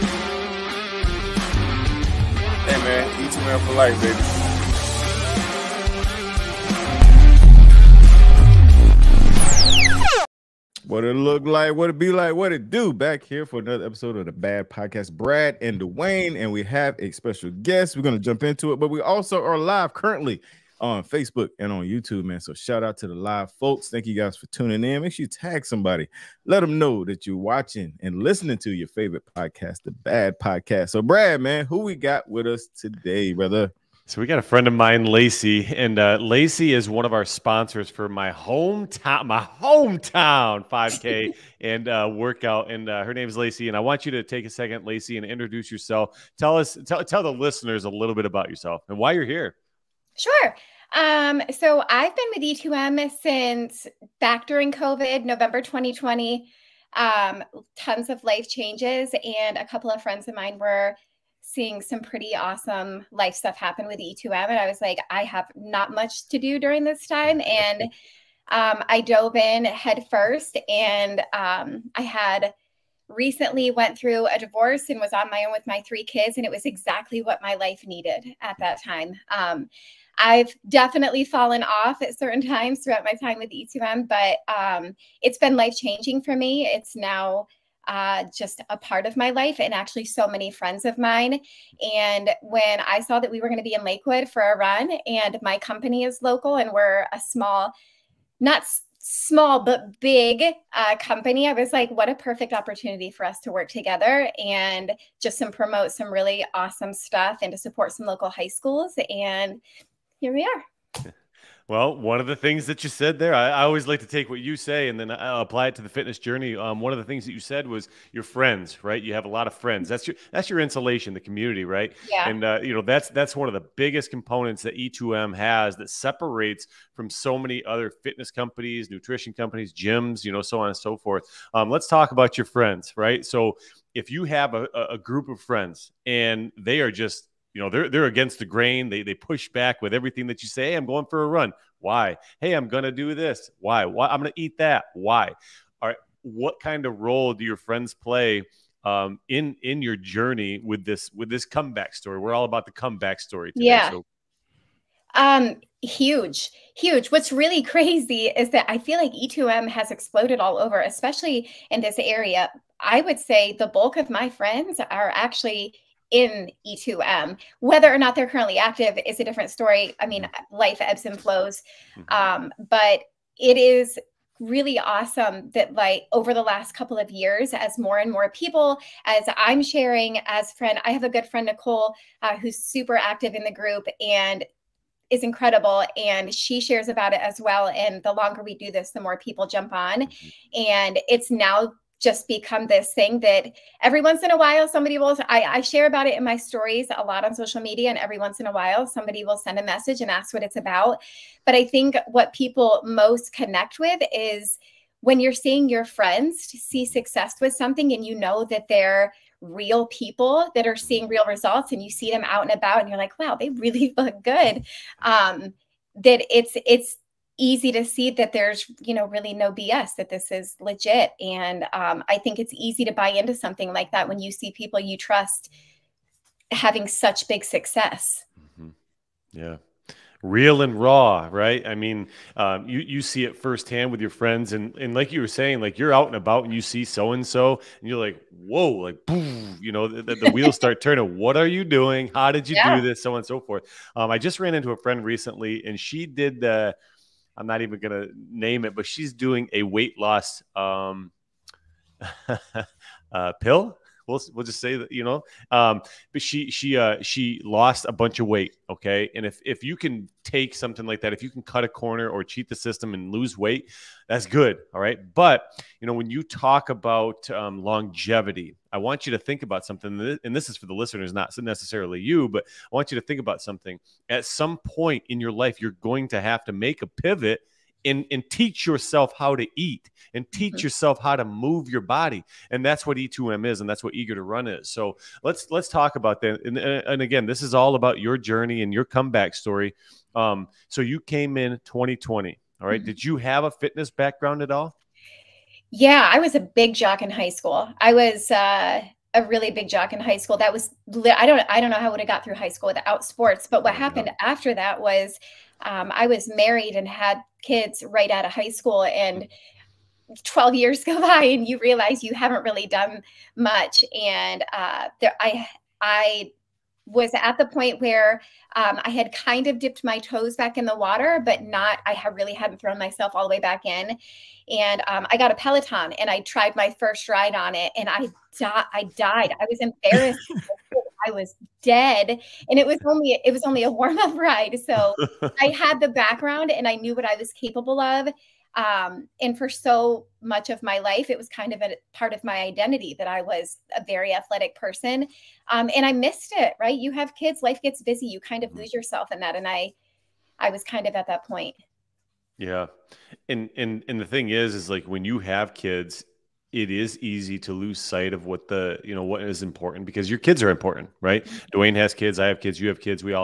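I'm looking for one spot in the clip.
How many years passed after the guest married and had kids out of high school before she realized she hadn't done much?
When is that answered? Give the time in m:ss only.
5:10.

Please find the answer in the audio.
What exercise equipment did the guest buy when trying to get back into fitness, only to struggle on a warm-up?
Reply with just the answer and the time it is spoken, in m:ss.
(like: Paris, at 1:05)
Peloton, at 5:25.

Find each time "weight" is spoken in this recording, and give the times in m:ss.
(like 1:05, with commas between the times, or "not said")
4:09, 4:18, 4:23.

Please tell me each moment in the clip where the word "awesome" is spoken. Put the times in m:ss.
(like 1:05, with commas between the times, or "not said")
1:02, 1:46, 2:54.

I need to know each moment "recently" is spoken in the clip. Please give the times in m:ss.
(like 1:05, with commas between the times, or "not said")
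1:13, 4:05.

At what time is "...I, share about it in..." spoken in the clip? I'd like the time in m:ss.
3:15.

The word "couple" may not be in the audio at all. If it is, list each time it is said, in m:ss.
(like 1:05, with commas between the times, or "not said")
0:59, 2:56.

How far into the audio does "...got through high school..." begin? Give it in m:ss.
5:02.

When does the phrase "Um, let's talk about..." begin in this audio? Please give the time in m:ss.
2:11.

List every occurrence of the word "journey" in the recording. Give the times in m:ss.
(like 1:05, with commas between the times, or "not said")
1:56, 2:29, 4:48.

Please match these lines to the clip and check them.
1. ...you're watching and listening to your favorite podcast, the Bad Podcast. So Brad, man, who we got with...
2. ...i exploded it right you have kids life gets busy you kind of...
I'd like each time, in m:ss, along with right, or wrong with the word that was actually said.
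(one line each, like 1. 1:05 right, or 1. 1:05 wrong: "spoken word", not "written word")
1. 0:27 right
2. 5:45 wrong: "missed", not "exploded".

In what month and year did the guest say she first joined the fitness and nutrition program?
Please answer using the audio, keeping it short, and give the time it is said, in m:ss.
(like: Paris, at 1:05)
November 2020, at 0:55.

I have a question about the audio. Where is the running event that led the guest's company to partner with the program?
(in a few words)
Lakewood.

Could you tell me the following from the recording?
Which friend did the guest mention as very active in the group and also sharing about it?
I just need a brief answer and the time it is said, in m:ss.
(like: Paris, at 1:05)
Nicole, at 3:01.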